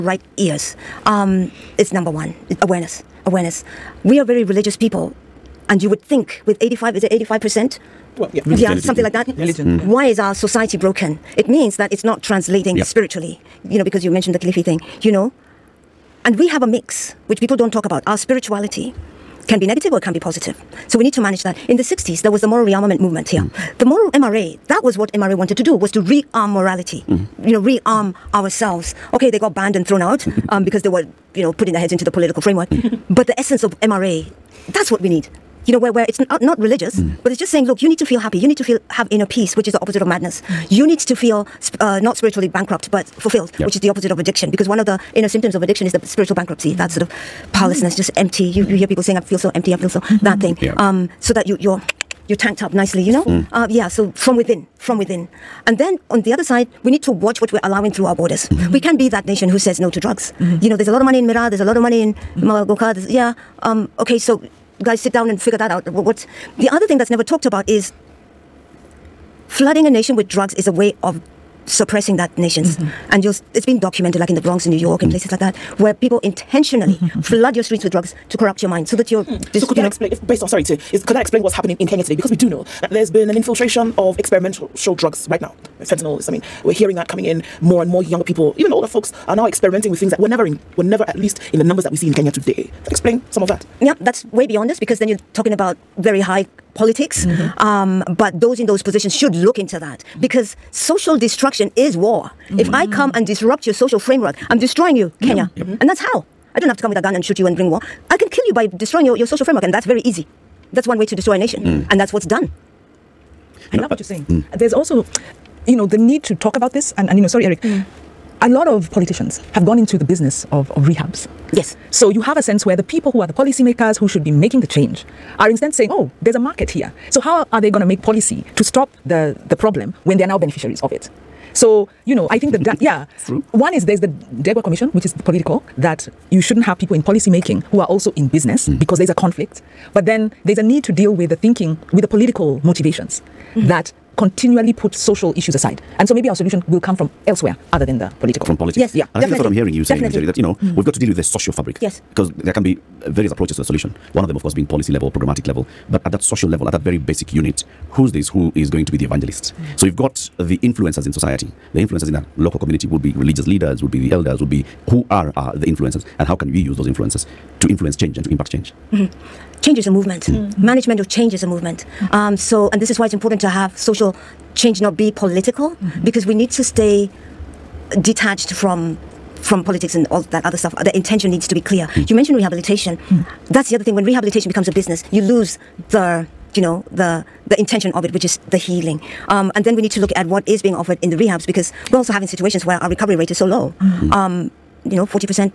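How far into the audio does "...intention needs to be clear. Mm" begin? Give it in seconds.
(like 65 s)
180 s.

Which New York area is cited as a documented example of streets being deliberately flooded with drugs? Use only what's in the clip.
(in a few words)
The Bronx.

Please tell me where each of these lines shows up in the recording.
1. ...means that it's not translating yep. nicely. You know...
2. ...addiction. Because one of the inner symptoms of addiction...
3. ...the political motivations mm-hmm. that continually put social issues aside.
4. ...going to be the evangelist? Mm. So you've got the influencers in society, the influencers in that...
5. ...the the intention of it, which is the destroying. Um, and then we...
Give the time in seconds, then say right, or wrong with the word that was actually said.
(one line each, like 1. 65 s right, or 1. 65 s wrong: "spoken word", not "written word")
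1. 11 s wrong: "spiritually", not "nicely"
2. 44 s right
3. 142 s right
4. 158 s right
5. 186 s wrong: "healing", not "destroying".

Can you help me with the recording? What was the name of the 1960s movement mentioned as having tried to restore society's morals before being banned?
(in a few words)
Moral Rearmament Movement.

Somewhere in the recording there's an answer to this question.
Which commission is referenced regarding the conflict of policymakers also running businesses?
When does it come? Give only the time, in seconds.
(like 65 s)
134 s.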